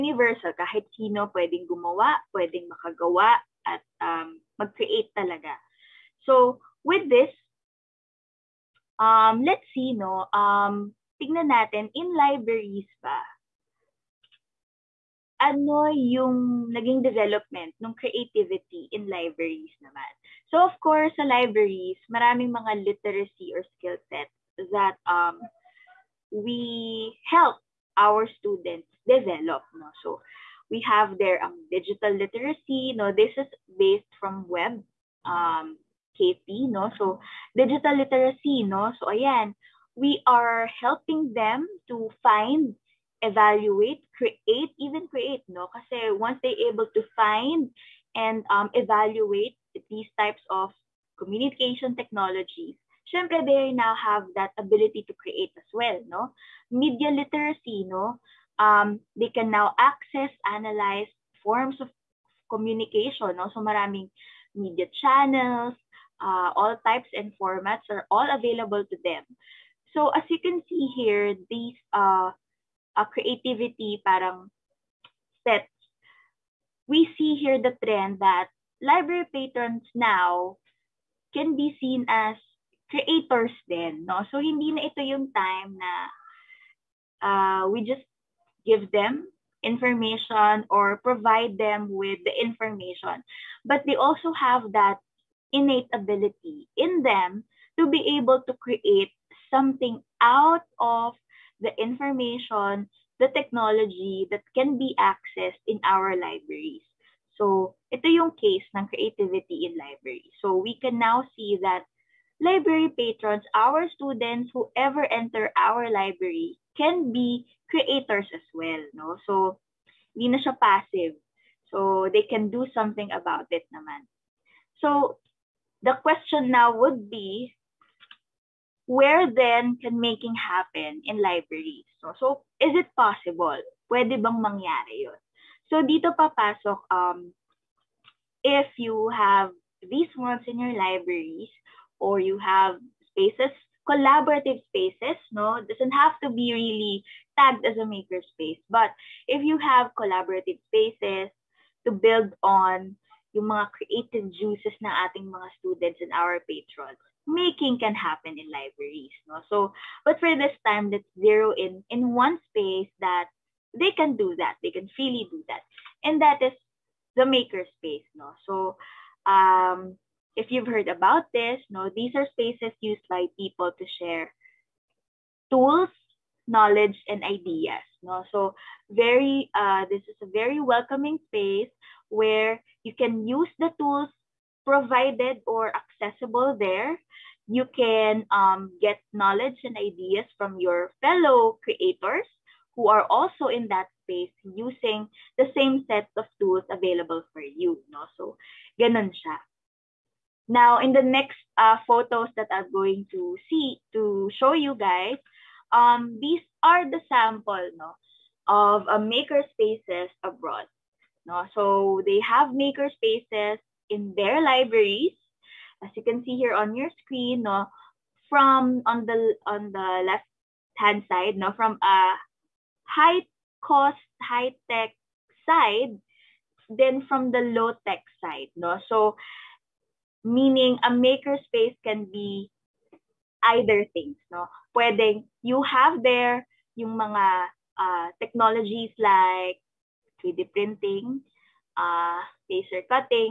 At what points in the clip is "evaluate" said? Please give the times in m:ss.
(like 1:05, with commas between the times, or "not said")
0:43, 0:48.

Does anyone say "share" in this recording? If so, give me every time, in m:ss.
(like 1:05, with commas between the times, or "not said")
2:54.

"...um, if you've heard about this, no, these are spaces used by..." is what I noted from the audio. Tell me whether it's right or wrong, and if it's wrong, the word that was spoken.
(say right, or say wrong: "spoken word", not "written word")
right.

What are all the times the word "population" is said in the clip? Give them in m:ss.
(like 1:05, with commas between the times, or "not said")
not said.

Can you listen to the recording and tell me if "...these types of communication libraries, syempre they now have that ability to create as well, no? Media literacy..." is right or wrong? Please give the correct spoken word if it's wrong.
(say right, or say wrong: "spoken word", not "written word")
wrong: "technologies", not "libraries".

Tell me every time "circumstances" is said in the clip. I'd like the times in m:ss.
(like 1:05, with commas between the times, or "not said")
not said.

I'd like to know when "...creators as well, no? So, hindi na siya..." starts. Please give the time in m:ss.
1:57.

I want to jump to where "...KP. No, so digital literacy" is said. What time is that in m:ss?
0:36.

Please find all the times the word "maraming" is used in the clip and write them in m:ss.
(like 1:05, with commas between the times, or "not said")
0:22, 1:03.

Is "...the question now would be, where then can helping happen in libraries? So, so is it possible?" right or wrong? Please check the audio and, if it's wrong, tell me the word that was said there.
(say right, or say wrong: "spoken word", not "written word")
wrong: "making", not "helping".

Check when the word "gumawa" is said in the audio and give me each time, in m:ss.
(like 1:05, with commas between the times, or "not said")
0:01.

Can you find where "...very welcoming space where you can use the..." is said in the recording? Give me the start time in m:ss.
3:00.